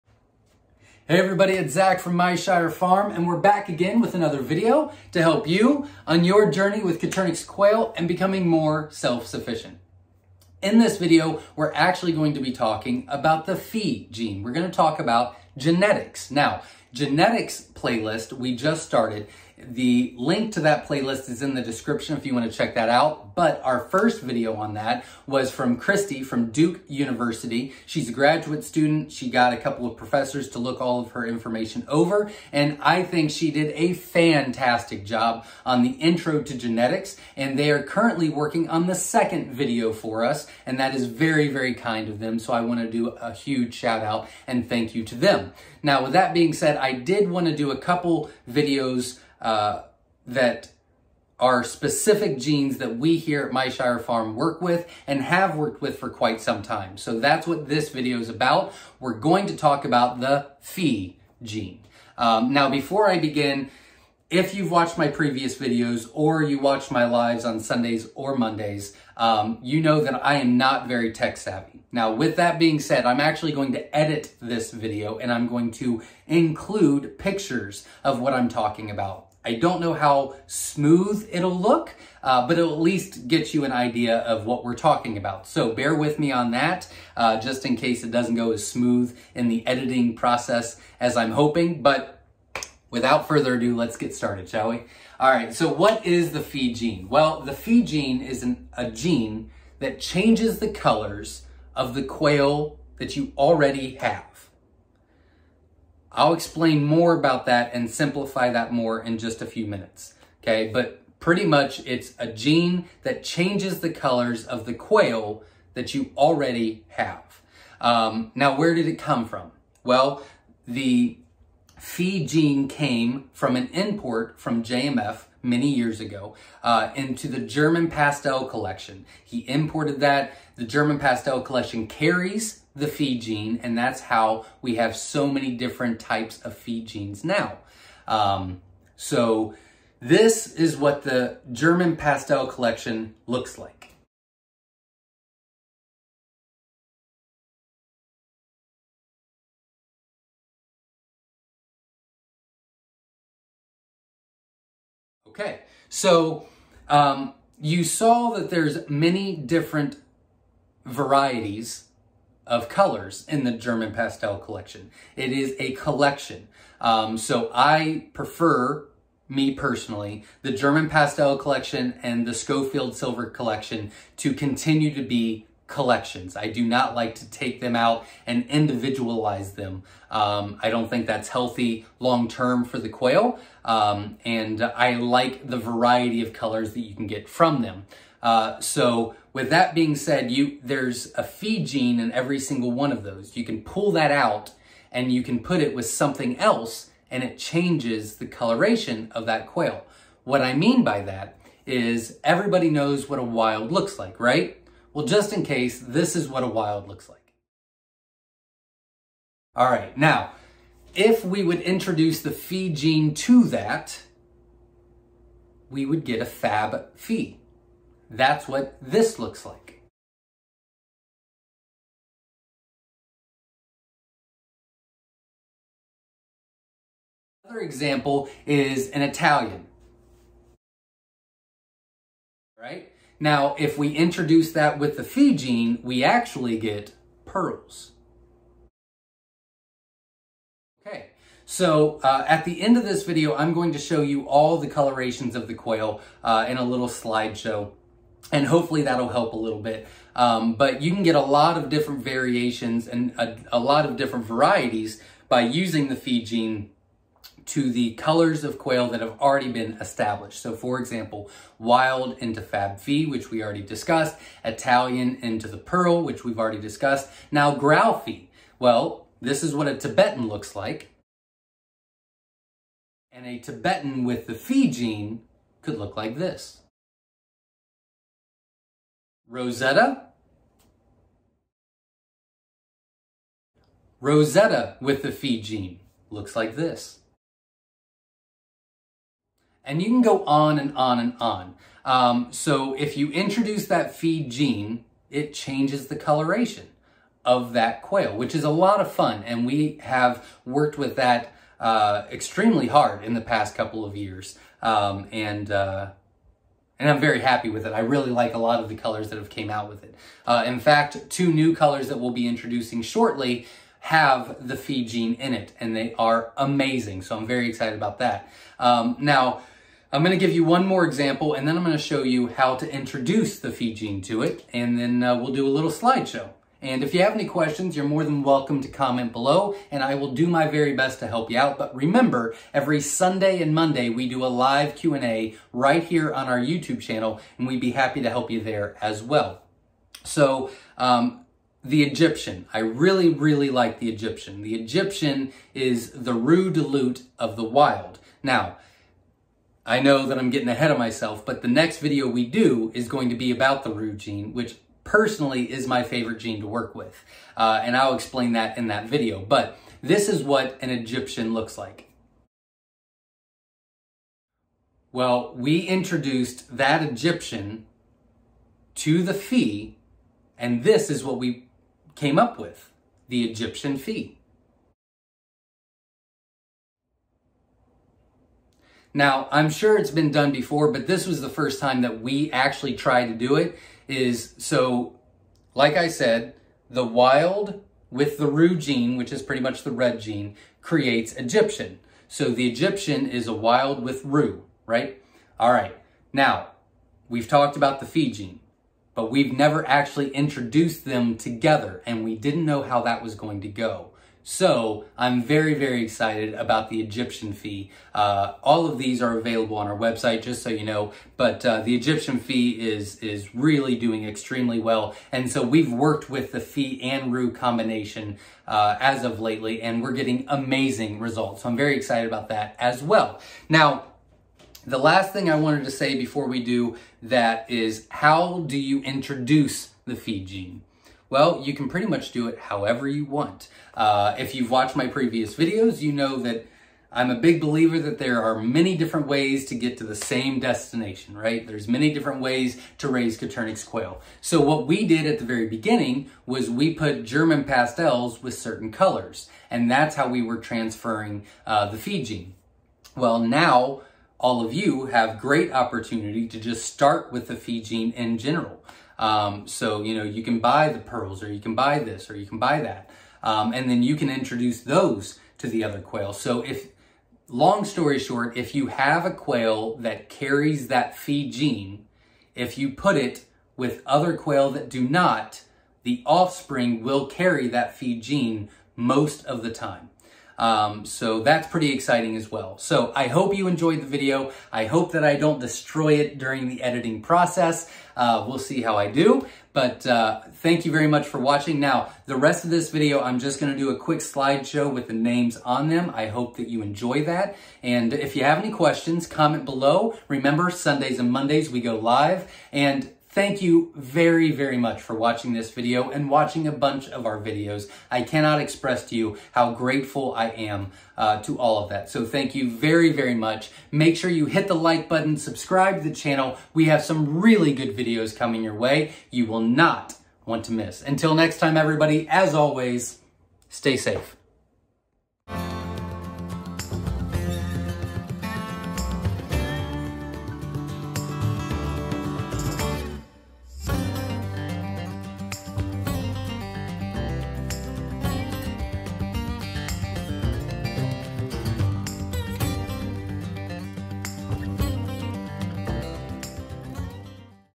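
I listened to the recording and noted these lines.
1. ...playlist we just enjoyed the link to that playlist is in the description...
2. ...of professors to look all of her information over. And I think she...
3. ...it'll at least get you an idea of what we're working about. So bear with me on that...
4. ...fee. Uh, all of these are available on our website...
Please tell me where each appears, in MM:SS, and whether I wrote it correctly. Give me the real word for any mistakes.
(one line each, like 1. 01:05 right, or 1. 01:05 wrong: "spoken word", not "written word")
1. 00:17 wrong: "started", not "enjoyed"
2. 00:29 right
3. 01:22 wrong: "talking", not "working"
4. 06:47 right.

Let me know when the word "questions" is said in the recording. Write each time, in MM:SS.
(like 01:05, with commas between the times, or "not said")
05:27, 08:18.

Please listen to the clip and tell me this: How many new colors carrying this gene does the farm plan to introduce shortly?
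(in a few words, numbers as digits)
2.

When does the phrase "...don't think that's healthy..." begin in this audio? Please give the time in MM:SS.
03:00.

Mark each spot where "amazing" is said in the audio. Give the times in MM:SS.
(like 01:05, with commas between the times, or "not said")
05:16, 07:00.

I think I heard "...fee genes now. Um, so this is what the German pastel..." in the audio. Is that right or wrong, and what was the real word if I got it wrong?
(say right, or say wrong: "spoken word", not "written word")
right.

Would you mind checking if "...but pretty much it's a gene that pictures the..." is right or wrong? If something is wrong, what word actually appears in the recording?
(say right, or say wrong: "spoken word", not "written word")
wrong: "changes", not "pictures".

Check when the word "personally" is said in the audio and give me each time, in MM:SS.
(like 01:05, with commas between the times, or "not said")
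02:49, 05:54.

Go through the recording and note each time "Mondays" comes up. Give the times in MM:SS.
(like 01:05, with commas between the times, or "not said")
01:08, 05:33, 08:21.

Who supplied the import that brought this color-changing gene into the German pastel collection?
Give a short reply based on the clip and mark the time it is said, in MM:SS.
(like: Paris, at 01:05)
JMF, at 02:04.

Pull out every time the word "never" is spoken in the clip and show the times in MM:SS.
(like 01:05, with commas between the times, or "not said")
06:39.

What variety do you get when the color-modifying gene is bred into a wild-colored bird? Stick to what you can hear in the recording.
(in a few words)
Fab fee.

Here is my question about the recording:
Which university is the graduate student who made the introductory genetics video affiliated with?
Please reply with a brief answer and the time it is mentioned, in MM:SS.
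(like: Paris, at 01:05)
Duke University, at 00:26.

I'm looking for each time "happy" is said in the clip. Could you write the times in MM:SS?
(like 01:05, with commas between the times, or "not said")
05:07, 05:37.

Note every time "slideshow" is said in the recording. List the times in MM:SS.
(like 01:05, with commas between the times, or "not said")
04:06, 05:25, 08:13.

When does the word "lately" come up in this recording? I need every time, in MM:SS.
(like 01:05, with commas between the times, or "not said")
06:59.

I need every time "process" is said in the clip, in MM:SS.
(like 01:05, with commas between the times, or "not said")
01:30, 08:07.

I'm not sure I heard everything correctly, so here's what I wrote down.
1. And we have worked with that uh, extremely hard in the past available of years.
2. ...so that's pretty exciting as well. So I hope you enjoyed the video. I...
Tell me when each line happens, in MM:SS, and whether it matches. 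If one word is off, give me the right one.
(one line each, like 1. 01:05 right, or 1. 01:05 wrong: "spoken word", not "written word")
1. 04:59 wrong: "couple", not "available"
2. 08:00 right.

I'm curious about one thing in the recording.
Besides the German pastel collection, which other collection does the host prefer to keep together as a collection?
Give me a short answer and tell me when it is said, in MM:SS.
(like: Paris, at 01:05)
Schofield silver collection, at 02:52.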